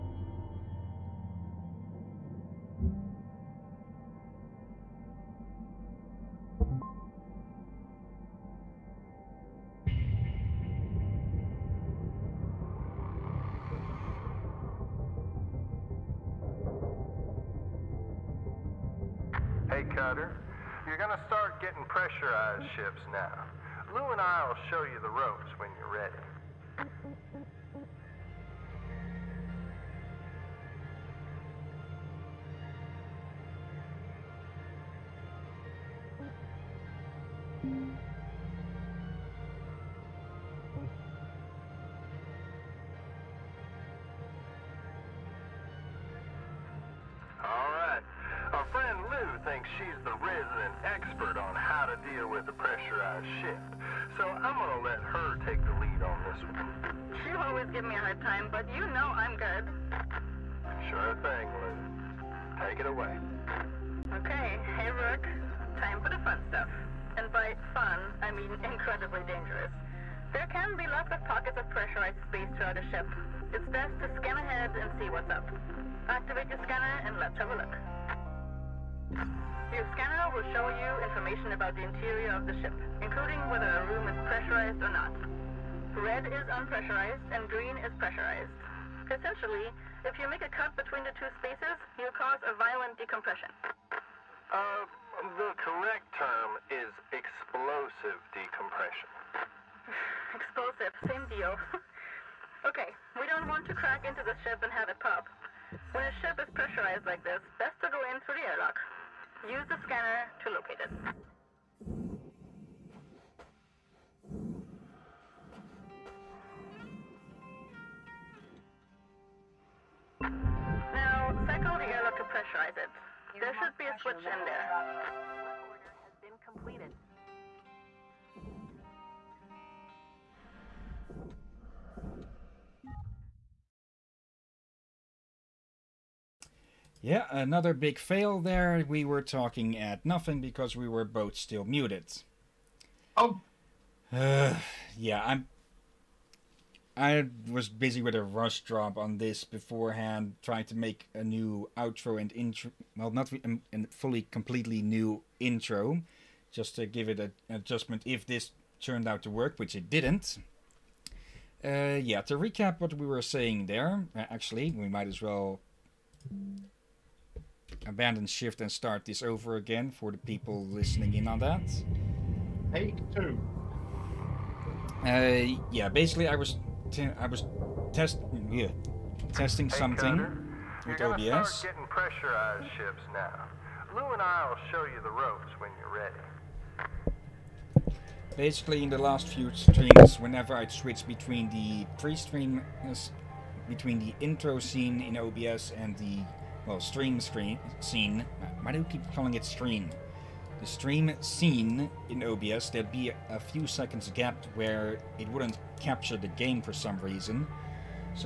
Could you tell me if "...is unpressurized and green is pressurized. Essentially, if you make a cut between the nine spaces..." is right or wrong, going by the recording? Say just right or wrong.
wrong.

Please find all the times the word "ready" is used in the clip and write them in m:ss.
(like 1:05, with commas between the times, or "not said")
3:05.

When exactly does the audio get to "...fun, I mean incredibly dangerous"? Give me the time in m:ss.
1:07.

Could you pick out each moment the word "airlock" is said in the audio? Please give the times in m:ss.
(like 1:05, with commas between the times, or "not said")
1:48, 2:01.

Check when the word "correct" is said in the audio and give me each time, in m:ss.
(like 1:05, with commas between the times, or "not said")
1:35.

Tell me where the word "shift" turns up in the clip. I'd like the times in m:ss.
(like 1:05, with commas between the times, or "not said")
0:53, 2:48.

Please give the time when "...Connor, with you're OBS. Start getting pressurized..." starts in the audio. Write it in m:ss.
2:59.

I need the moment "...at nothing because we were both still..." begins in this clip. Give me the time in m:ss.
2:19.